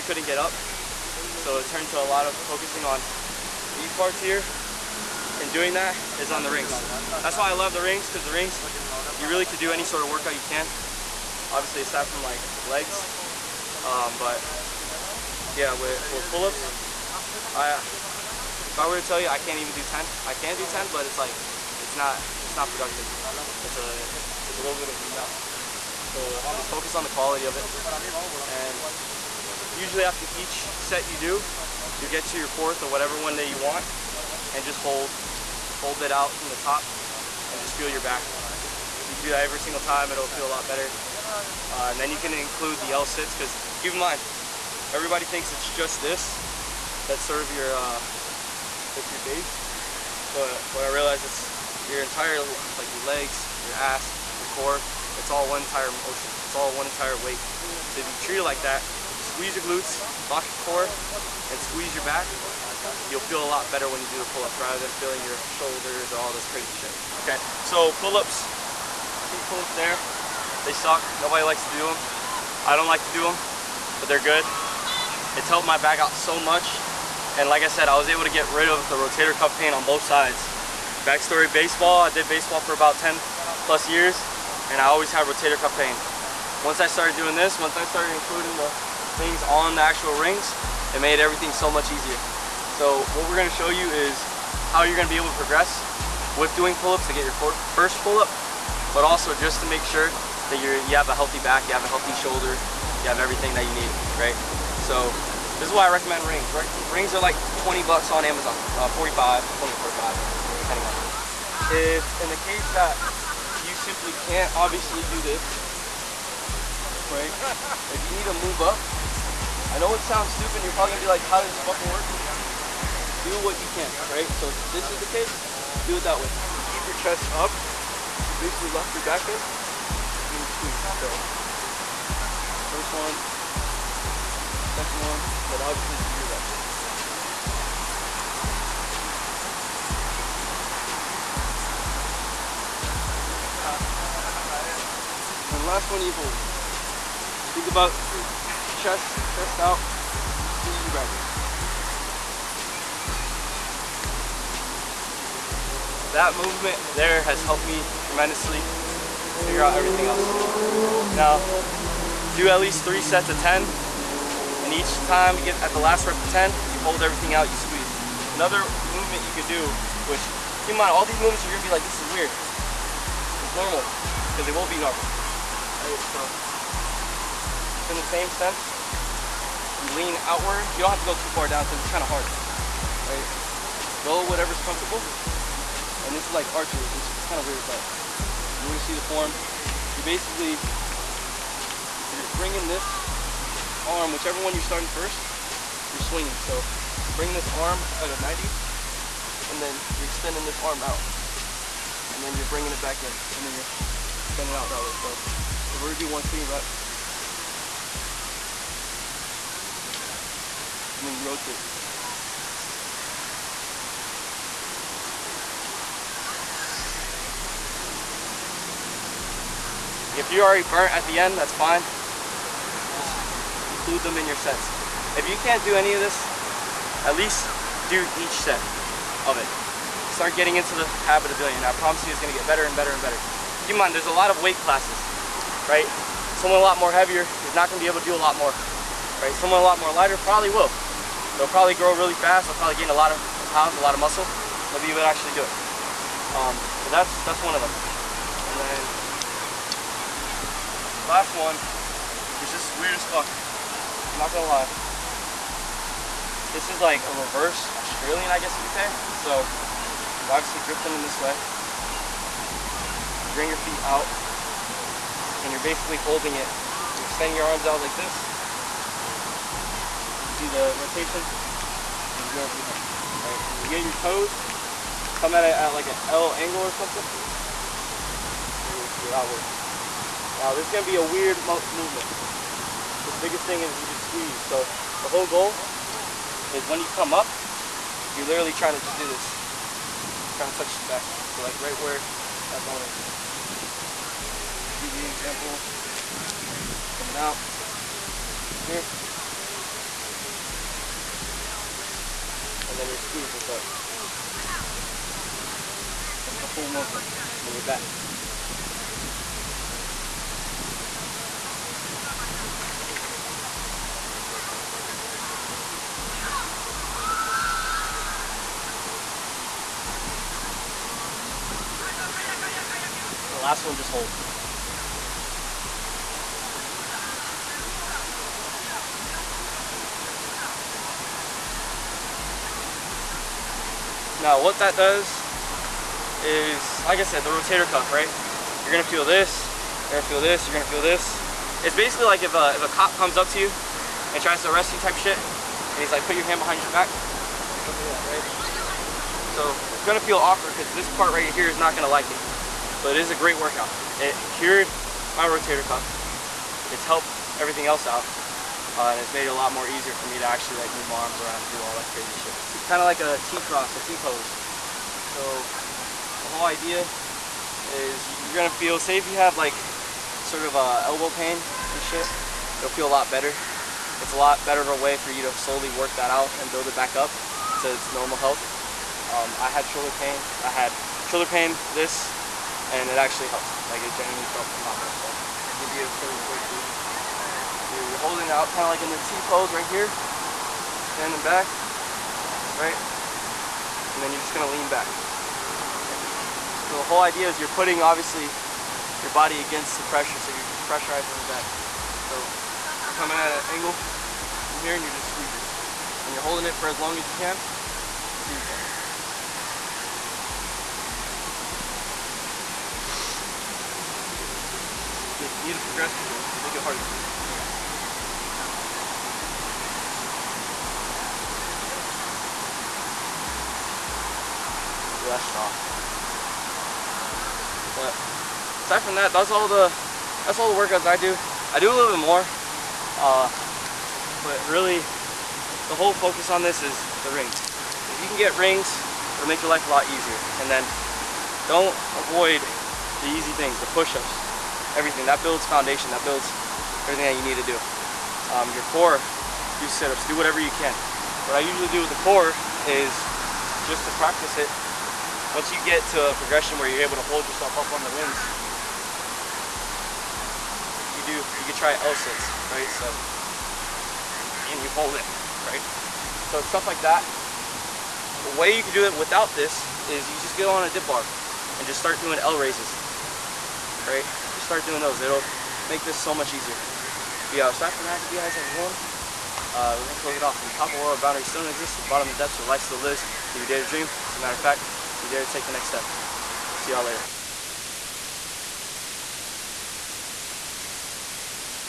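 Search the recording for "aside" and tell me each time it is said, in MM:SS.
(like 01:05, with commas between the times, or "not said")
00:11, 07:08, 07:57.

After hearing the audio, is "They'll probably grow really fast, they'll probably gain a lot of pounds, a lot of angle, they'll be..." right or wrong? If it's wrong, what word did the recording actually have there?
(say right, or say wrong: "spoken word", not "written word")
wrong: "muscle", not "angle".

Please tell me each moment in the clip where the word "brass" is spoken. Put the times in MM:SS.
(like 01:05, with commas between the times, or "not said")
not said.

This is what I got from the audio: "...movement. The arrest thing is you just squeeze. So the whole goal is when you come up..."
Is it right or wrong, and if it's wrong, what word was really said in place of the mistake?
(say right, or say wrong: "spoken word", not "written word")
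wrong: "biggest", not "arrest".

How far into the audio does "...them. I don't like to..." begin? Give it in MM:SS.
01:11.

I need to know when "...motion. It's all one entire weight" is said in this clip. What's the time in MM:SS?
00:55.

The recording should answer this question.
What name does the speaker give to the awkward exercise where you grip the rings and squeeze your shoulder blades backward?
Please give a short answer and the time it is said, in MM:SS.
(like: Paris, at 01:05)
Reverse Australian, at 04:17.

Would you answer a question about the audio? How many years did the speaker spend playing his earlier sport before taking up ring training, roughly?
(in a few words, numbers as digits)
10 plus years.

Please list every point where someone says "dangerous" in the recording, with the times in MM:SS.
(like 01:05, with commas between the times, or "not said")
not said.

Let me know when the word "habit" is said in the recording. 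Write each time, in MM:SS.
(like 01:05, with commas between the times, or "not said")
03:51.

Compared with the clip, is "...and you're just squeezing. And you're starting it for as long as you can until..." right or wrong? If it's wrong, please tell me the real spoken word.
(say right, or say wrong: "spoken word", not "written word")
wrong: "holding", not "starting".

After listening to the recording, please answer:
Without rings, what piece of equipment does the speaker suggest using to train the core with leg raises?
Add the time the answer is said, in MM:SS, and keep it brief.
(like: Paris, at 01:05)
Dip bar, at 07:50.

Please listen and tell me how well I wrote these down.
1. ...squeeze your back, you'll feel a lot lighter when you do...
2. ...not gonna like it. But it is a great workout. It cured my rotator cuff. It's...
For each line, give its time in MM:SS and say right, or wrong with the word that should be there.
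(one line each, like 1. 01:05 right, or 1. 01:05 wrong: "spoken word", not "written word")
1. 01:01 wrong: "better", not "lighter"
2. 05:51 right.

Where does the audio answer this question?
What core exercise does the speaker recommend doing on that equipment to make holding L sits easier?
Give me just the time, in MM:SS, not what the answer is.
07:52.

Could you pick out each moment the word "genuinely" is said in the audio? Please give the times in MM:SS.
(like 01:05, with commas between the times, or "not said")
06:23.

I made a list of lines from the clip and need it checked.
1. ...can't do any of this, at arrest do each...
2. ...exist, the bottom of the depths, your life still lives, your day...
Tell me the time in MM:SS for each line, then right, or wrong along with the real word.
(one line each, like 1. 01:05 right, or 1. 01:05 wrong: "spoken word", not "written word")
1. 03:45 wrong: "least", not "arrest"
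2. 08:01 right.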